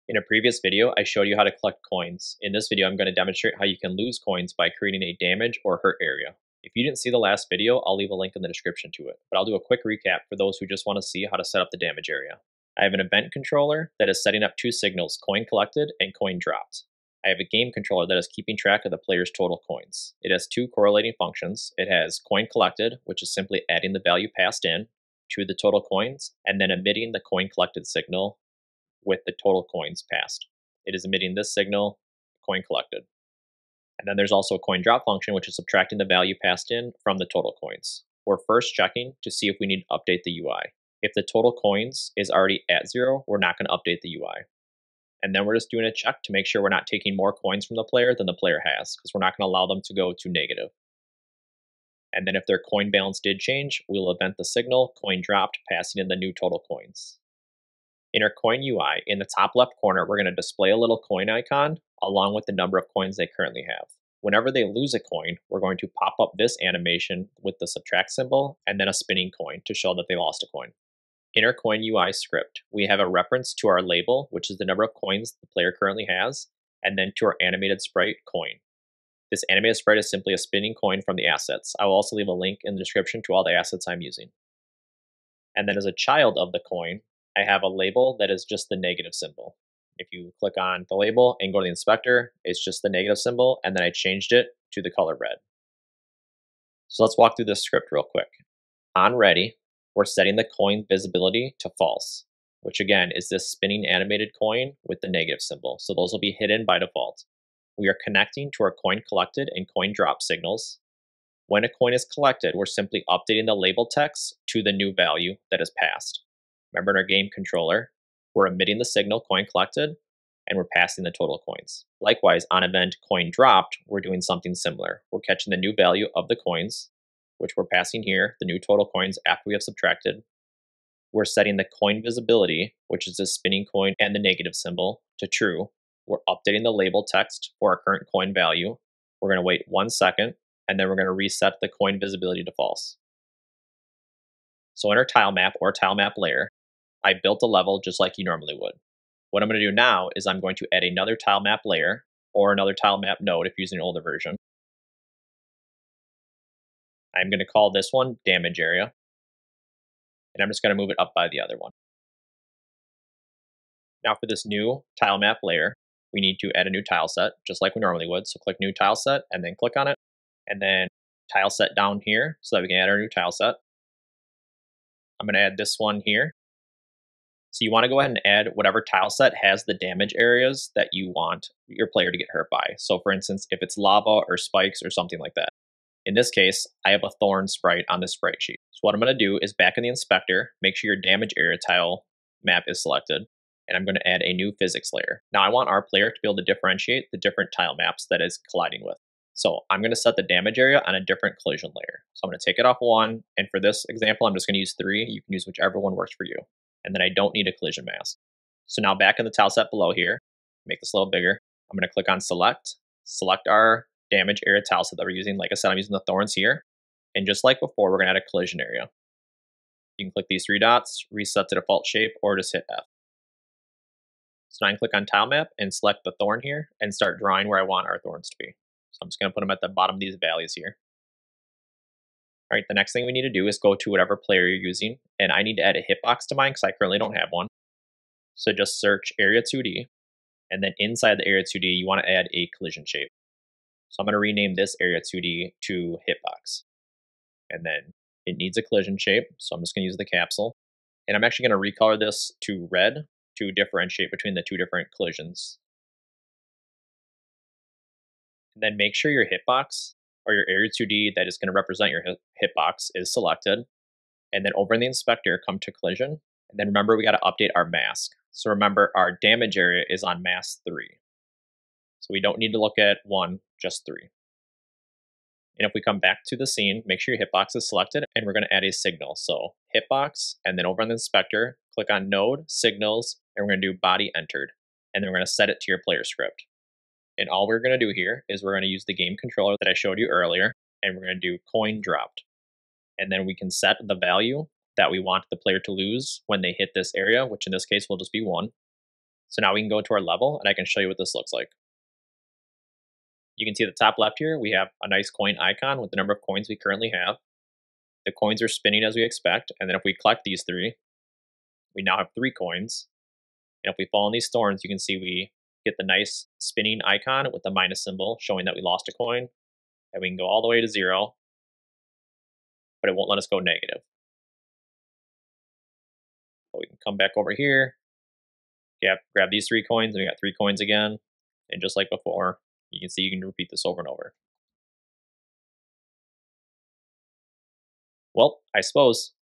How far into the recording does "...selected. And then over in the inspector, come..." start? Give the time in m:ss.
4:23.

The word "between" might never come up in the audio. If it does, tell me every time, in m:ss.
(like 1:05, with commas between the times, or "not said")
4:14.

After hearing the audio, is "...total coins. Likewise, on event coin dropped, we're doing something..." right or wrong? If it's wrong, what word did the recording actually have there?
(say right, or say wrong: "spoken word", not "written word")
right.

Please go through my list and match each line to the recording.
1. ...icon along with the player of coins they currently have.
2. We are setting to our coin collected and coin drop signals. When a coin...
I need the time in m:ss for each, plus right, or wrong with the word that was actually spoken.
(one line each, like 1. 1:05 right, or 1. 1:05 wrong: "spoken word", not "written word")
1. 1:01 wrong: "number", not "player"
2. 1:47 wrong: "connecting", not "setting".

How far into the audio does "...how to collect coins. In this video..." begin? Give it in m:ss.
0:01.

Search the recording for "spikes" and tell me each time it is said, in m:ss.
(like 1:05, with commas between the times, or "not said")
3:04.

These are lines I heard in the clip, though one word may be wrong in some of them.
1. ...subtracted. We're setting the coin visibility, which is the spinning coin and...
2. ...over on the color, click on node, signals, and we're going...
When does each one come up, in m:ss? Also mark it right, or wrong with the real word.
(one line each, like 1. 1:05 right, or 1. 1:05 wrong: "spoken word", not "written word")
1. 2:09 right
2. 4:40 wrong: "inspector", not "color".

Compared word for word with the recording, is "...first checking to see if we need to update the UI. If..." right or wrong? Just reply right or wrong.
right.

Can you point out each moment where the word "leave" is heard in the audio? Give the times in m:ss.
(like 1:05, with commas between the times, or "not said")
0:07, 1:22.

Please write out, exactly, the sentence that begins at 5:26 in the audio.
But we can come back over here, grab, grab these three coins, and we got three coins again.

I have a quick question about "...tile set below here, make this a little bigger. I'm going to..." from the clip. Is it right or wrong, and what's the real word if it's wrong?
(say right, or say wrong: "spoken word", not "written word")
right.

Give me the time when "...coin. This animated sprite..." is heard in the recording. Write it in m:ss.
1:18.